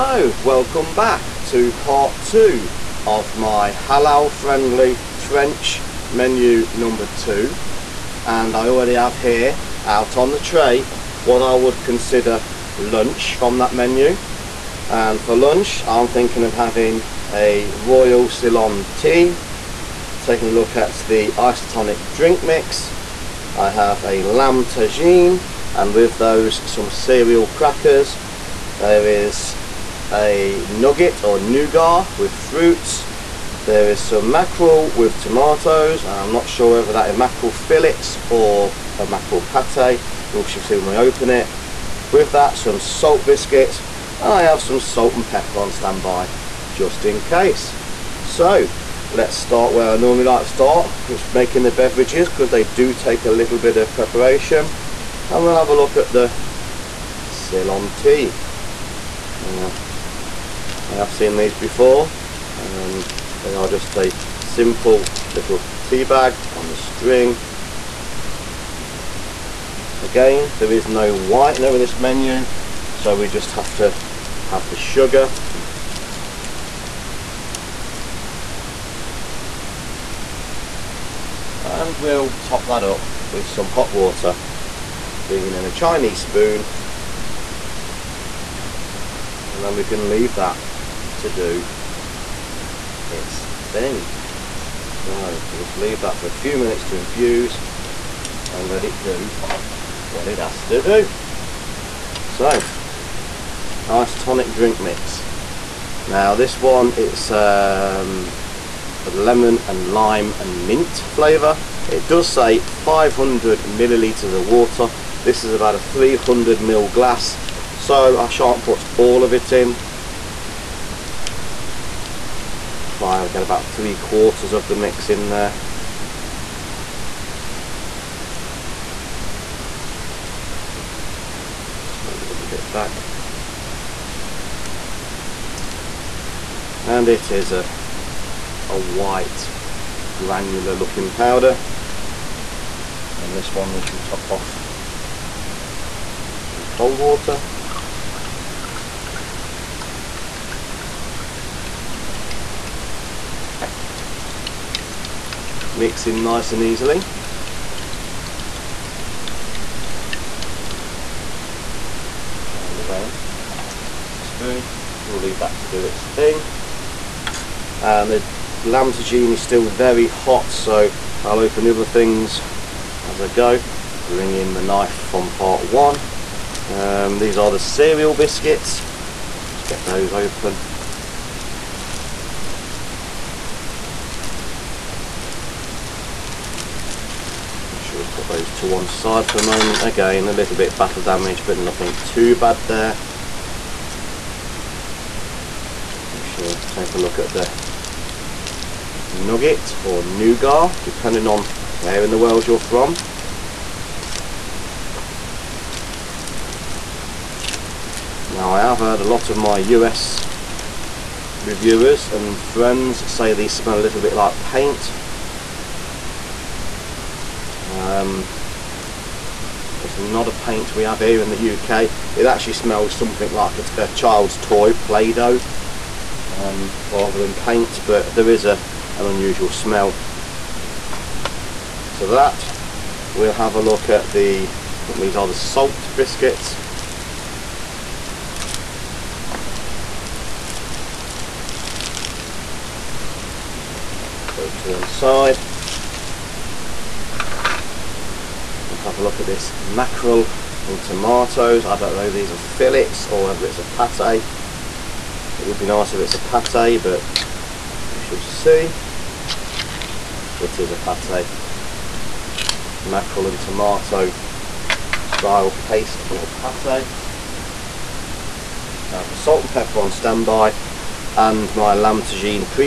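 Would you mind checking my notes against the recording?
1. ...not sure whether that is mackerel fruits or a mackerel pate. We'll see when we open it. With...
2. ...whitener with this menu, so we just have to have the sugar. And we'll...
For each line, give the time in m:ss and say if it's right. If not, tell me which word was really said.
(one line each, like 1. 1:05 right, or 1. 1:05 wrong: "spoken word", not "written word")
1. 0:36 wrong: "fillets", not "fruits"
2. 1:11 right.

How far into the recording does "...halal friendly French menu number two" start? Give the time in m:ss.
0:03.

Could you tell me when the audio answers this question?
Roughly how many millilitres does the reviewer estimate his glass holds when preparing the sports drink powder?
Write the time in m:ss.
1:55.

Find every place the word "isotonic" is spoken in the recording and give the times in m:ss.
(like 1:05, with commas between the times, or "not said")
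0:21, 1:43.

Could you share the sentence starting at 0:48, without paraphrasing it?
So let's start where I normally like to start.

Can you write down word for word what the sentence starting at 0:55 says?
And we'll have a look at the Ceylon tea.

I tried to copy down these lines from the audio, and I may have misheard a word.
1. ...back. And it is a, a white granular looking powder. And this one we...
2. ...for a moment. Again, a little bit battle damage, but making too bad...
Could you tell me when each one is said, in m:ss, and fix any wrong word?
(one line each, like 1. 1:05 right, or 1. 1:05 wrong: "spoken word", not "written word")
1. 2:12 right
2. 3:09 wrong: "nothing", not "making".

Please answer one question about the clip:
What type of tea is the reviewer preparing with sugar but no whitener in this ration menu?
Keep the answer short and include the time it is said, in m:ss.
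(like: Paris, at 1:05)
Royal Ceylon tea, at 0:17.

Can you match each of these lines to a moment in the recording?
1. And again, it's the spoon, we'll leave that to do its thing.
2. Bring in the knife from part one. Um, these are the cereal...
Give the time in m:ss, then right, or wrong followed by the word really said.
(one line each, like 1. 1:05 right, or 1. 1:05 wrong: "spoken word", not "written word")
1. 2:42 right
2. 2:54 right.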